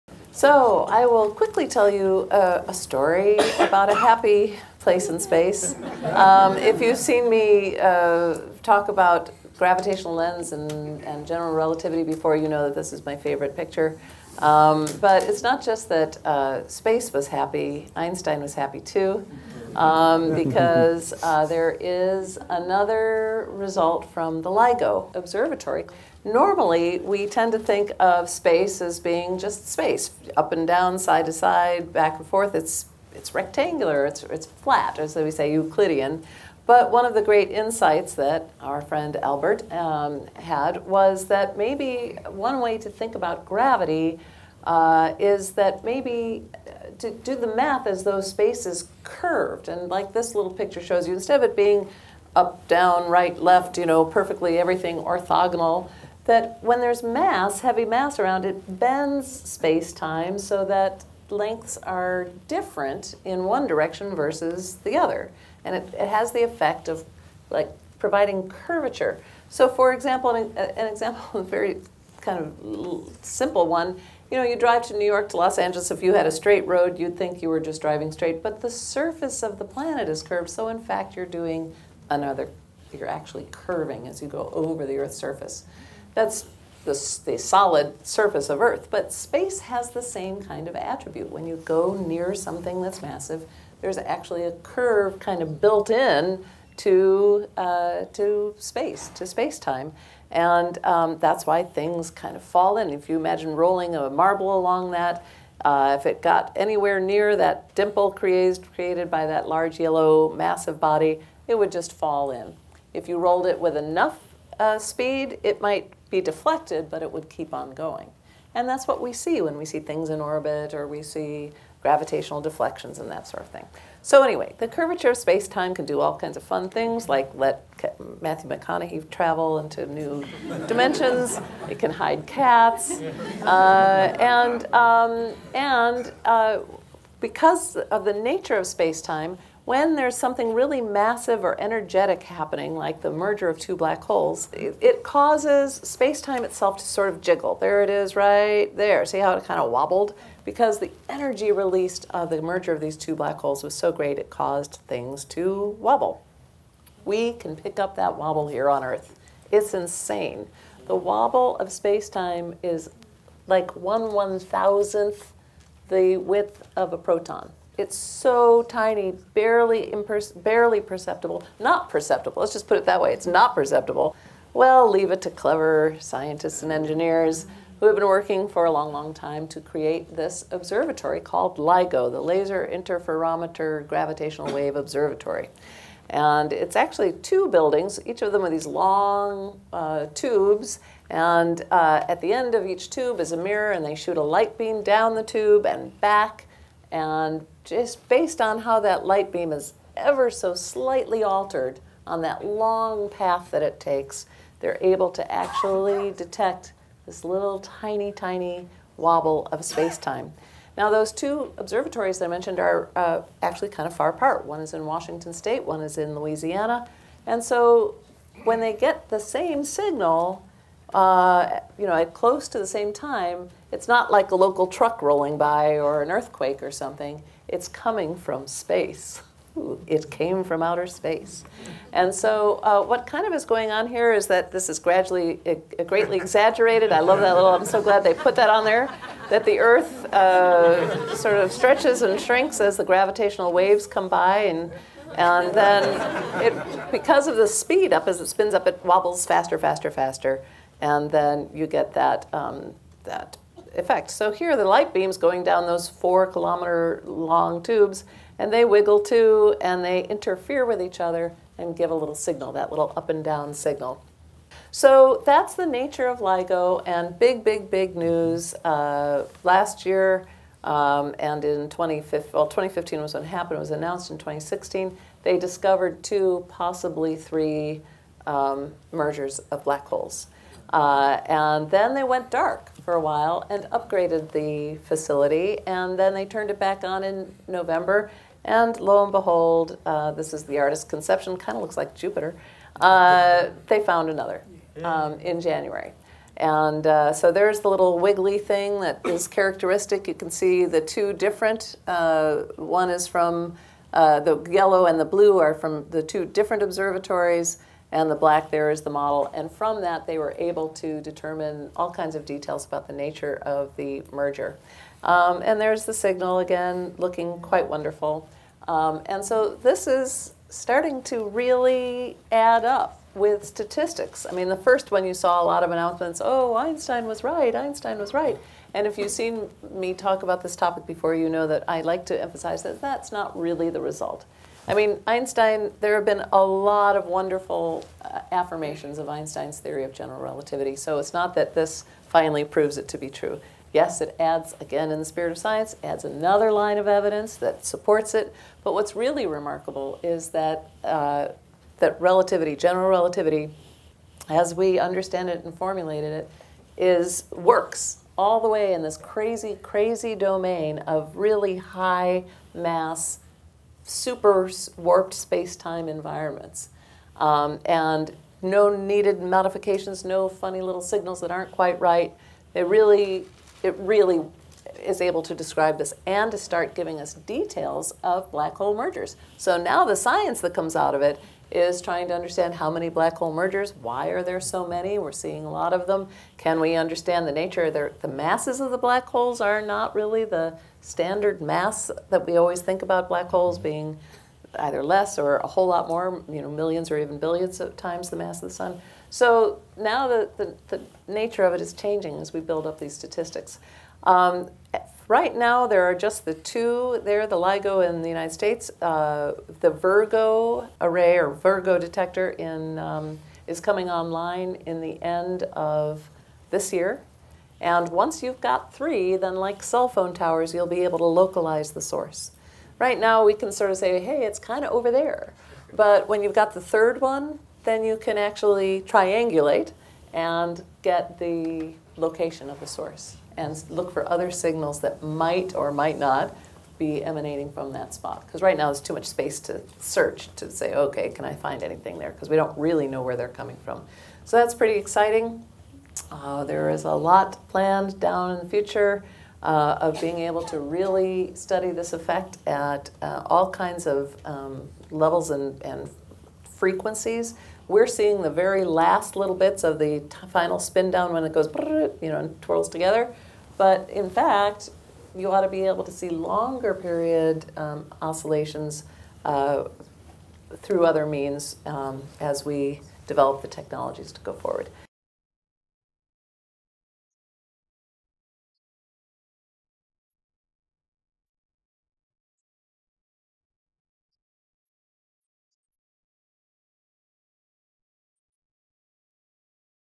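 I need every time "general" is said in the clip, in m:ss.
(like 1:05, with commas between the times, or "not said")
0:11, 5:39, 5:52.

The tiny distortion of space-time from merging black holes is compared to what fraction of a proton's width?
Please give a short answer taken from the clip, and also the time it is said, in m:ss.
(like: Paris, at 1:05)
One thousandth, at 2:43.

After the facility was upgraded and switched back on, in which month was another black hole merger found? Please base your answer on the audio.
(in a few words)
January.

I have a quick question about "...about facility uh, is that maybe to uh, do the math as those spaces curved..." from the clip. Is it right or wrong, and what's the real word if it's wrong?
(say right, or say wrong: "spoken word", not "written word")
wrong: "gravity", not "facility".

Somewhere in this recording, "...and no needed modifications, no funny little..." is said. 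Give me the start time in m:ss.
6:07.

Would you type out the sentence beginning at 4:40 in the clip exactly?
Uh, and then they went dark for a while and upgraded the facility, and then they turned it back on in November.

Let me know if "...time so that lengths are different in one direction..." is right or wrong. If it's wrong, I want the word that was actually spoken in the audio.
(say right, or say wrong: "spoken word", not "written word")
right.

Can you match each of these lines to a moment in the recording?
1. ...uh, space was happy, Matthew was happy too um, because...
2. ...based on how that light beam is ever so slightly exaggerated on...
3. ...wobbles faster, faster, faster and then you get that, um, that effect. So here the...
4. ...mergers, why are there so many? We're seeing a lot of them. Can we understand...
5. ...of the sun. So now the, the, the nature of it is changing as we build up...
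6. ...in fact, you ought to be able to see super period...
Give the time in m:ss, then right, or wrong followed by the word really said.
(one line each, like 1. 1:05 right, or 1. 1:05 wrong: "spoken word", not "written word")
1. 0:16 wrong: "Einstein", not "Matthew"
2. 3:18 wrong: "altered", not "exaggerated"
3. 4:08 right
4. 6:23 right
5. 6:38 right
6. 7:43 wrong: "longer", not "super".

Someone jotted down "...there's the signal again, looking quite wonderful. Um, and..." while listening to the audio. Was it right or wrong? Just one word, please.
right.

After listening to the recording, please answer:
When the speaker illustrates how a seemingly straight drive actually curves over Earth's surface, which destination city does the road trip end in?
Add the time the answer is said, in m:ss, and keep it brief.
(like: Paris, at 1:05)
Los Angeles, at 1:15.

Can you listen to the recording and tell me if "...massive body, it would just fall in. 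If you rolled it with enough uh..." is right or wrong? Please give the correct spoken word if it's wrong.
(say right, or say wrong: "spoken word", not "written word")
right.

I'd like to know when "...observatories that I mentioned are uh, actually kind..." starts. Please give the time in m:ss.
3:31.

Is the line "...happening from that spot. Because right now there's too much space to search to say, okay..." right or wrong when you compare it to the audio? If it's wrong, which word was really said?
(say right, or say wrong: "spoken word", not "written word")
wrong: "emanating", not "happening".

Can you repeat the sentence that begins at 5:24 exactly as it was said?
I mean, the first one you saw a lot of announcements oh, Einstein was right, Einstein was right.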